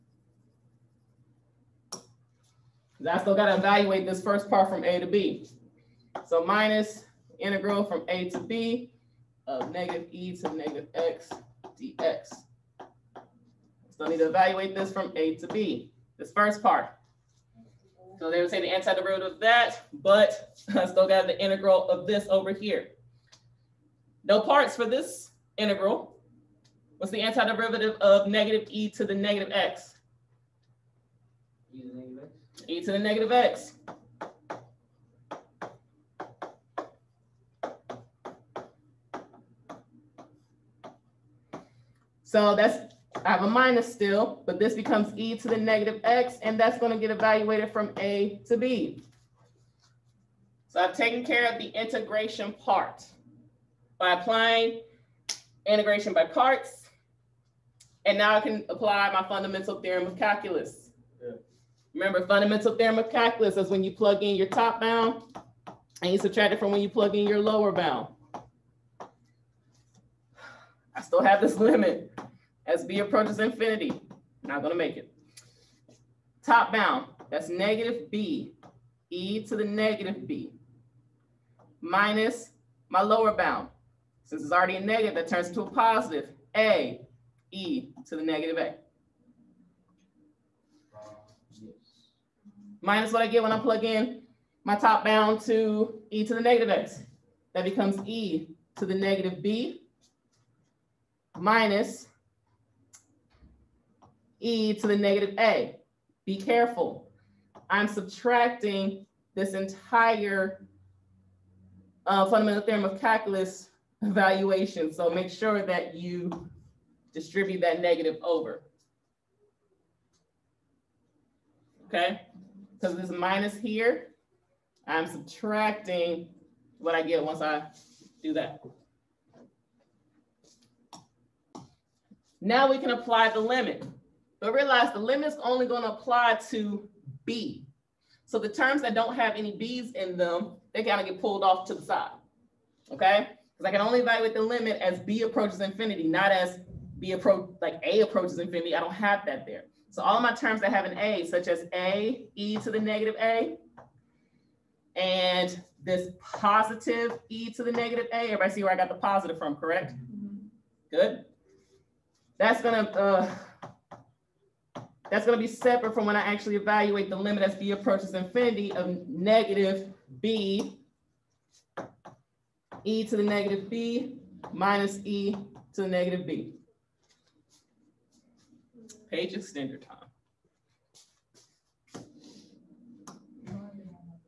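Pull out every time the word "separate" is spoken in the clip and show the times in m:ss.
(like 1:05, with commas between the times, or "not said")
2:45.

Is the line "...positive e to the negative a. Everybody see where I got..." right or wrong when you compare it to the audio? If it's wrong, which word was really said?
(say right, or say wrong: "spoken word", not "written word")
right.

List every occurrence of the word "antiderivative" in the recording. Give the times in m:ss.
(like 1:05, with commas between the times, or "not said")
0:18, 0:27.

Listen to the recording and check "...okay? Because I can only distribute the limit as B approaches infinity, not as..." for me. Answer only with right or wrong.
wrong.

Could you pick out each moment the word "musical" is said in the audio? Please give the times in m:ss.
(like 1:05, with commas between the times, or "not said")
not said.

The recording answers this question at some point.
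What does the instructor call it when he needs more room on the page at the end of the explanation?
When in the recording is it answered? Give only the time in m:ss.
2:59.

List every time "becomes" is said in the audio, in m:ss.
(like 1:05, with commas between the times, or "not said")
0:44, 1:37.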